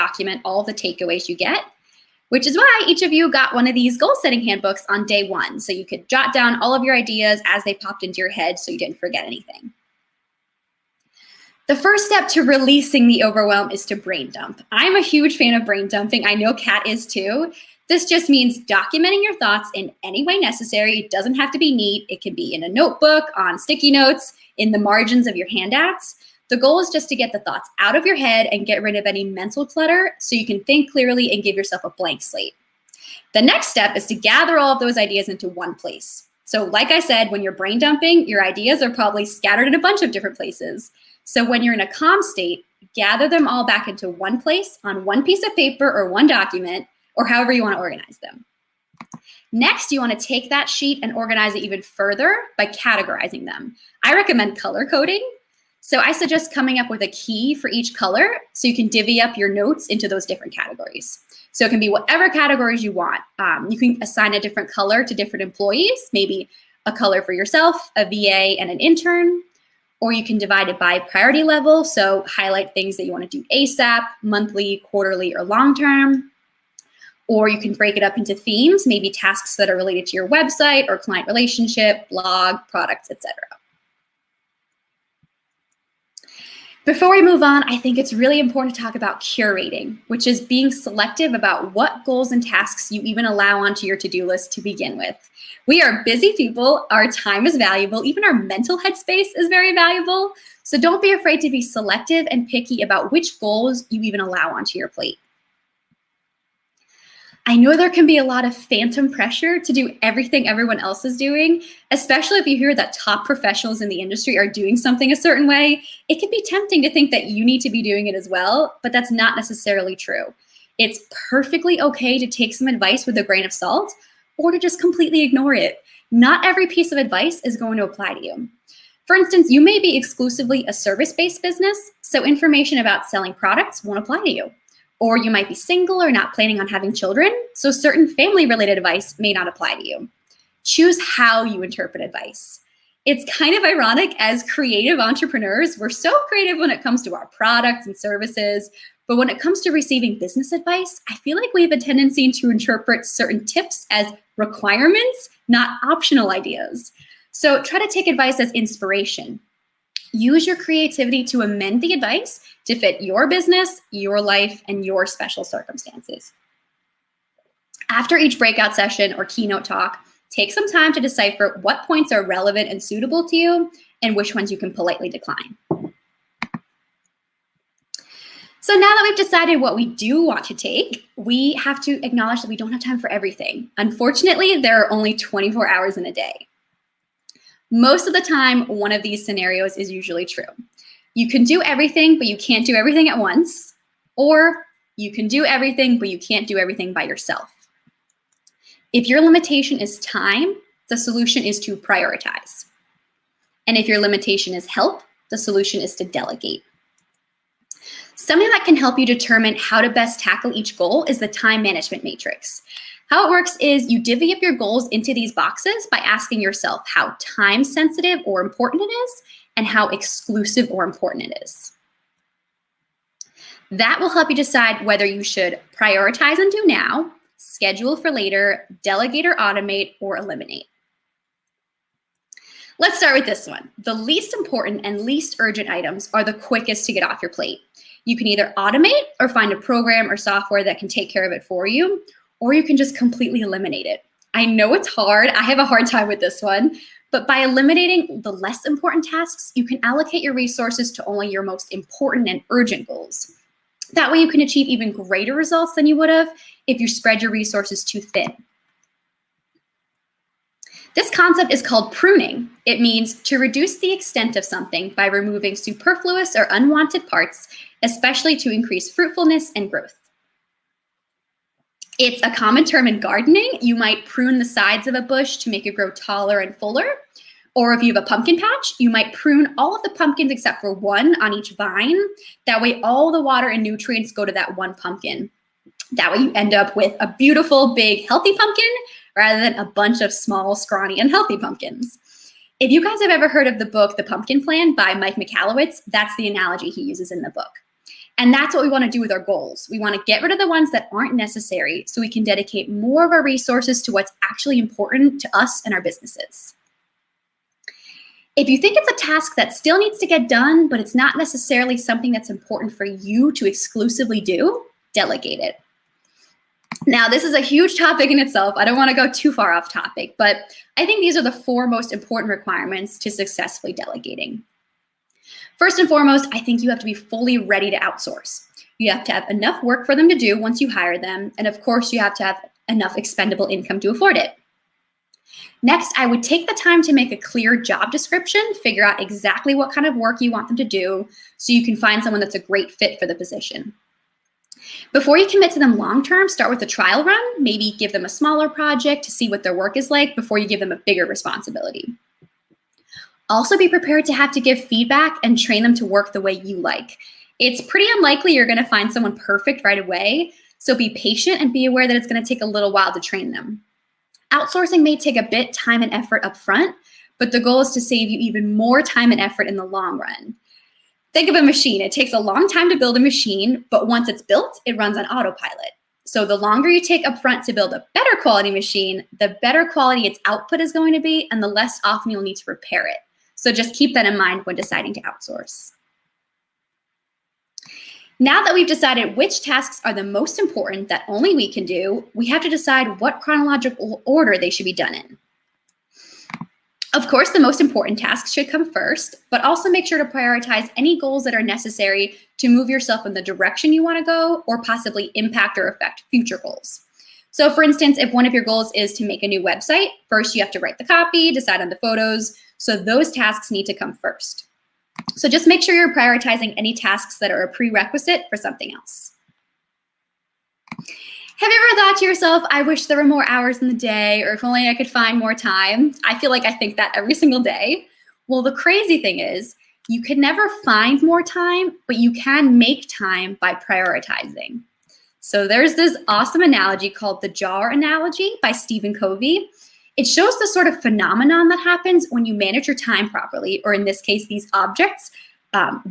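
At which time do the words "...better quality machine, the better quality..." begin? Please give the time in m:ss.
6:17.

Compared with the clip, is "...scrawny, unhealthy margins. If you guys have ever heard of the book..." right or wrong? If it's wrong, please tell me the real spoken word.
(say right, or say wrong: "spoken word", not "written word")
wrong: "pumpkins", not "margins".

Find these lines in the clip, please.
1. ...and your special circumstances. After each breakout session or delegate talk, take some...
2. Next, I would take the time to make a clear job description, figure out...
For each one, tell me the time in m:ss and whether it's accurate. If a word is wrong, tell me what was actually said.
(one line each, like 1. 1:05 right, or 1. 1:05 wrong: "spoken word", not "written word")
1. 2:44 wrong: "keynote", not "delegate"
2. 5:35 right.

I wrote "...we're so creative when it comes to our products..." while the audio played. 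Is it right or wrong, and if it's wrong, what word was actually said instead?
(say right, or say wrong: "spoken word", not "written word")
right.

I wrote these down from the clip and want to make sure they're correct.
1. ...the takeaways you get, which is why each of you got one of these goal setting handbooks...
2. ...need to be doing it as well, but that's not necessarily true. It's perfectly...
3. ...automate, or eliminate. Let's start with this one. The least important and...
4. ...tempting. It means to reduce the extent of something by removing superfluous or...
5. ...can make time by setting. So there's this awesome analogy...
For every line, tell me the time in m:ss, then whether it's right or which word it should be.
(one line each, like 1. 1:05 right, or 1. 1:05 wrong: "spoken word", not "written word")
1. 0:00 right
2. 1:57 right
3. 3:49 right
4. 4:21 wrong: "pruning", not "tempting"
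5. 7:12 wrong: "prioritizing", not "setting".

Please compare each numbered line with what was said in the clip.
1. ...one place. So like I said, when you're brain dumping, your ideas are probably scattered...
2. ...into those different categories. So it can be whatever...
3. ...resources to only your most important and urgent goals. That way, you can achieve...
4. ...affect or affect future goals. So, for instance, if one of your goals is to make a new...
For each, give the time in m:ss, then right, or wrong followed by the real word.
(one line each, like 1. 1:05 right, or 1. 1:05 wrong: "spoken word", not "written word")
1. 0:35 right
2. 0:59 right
3. 4:10 right
4. 6:45 wrong: "impact", not "affect".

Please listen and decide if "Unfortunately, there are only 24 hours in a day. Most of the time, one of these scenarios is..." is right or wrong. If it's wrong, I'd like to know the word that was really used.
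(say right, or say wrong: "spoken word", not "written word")
right.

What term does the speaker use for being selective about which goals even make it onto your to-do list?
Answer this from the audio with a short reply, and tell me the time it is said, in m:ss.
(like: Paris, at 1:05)
curating, at 1:29.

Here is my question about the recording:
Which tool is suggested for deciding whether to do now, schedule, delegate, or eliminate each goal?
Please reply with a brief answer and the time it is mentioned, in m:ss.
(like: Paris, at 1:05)
time management matrix, at 3:31.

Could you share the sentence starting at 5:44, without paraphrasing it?
Before you commit to them long term, start with a trial run.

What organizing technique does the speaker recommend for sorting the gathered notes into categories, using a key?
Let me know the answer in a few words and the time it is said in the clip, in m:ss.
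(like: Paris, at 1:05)
color coding, at 0:54.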